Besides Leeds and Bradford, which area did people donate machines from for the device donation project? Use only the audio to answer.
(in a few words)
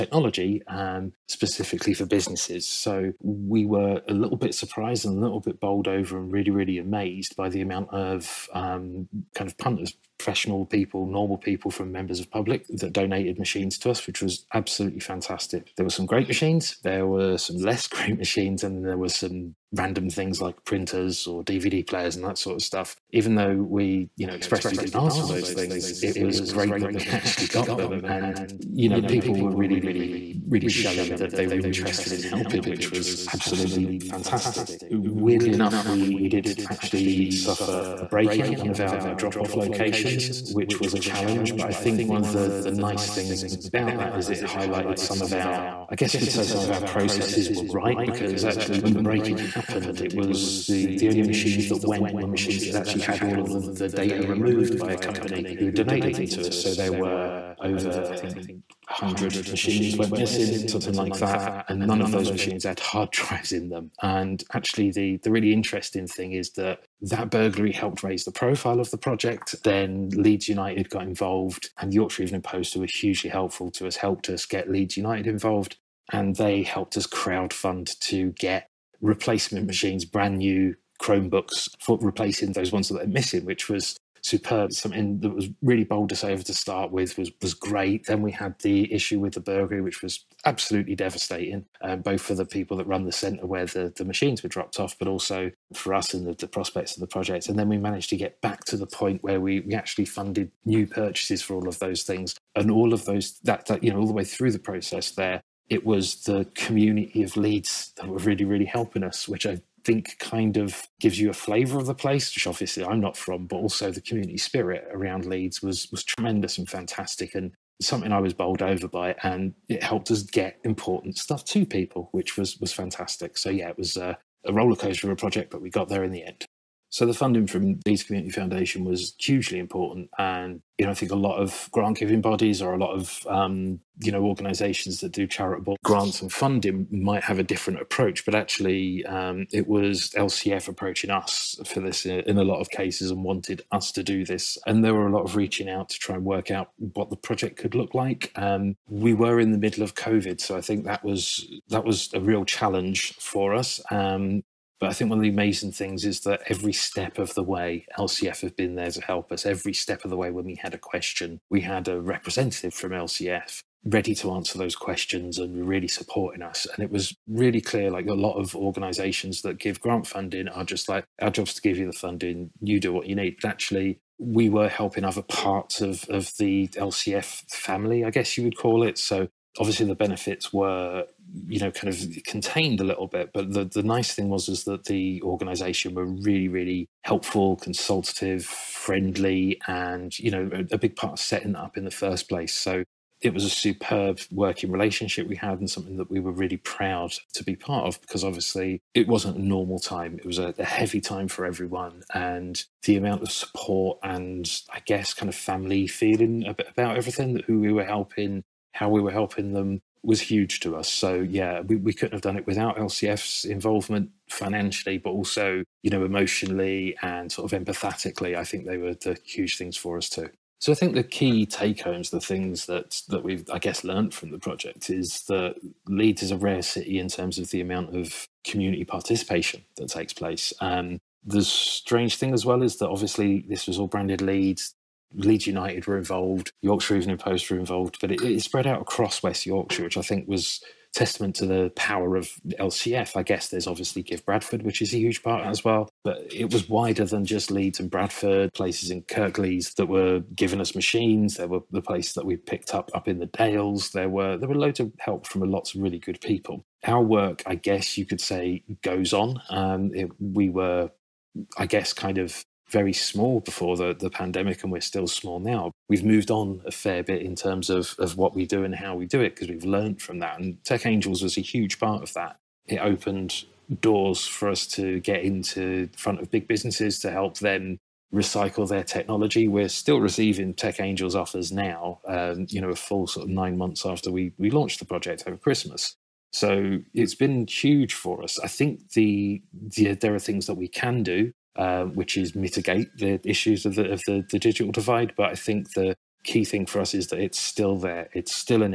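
Kirklees.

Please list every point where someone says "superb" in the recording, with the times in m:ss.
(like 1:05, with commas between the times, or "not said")
1:24, 3:13.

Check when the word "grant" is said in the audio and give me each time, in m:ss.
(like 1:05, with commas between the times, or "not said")
2:11, 2:15, 2:49.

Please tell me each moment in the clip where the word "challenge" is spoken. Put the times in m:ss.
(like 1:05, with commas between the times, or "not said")
0:40, 2:32.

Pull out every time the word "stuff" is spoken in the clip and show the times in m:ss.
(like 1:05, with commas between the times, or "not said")
0:22, 2:01.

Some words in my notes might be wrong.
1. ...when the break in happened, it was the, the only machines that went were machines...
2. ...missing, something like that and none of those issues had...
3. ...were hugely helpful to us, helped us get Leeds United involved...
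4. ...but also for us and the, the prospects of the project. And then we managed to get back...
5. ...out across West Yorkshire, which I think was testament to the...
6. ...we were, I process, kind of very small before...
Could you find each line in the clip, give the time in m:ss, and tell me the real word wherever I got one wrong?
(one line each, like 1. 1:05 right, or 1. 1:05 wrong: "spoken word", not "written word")
1. 0:48 right
2. 1:00 wrong: "machines", not "issues"
3. 1:12 right
4. 1:34 right
5. 3:58 right
6. 4:20 wrong: "guess", not "process".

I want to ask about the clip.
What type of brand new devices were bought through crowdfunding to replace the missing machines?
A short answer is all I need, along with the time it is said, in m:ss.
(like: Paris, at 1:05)
Chromebooks, at 1:20.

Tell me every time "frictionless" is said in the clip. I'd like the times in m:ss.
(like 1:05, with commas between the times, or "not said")
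not said.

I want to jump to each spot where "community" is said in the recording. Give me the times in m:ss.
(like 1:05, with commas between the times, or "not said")
1:46, 1:53, 2:08, 3:48.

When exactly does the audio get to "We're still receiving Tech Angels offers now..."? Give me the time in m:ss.
4:39.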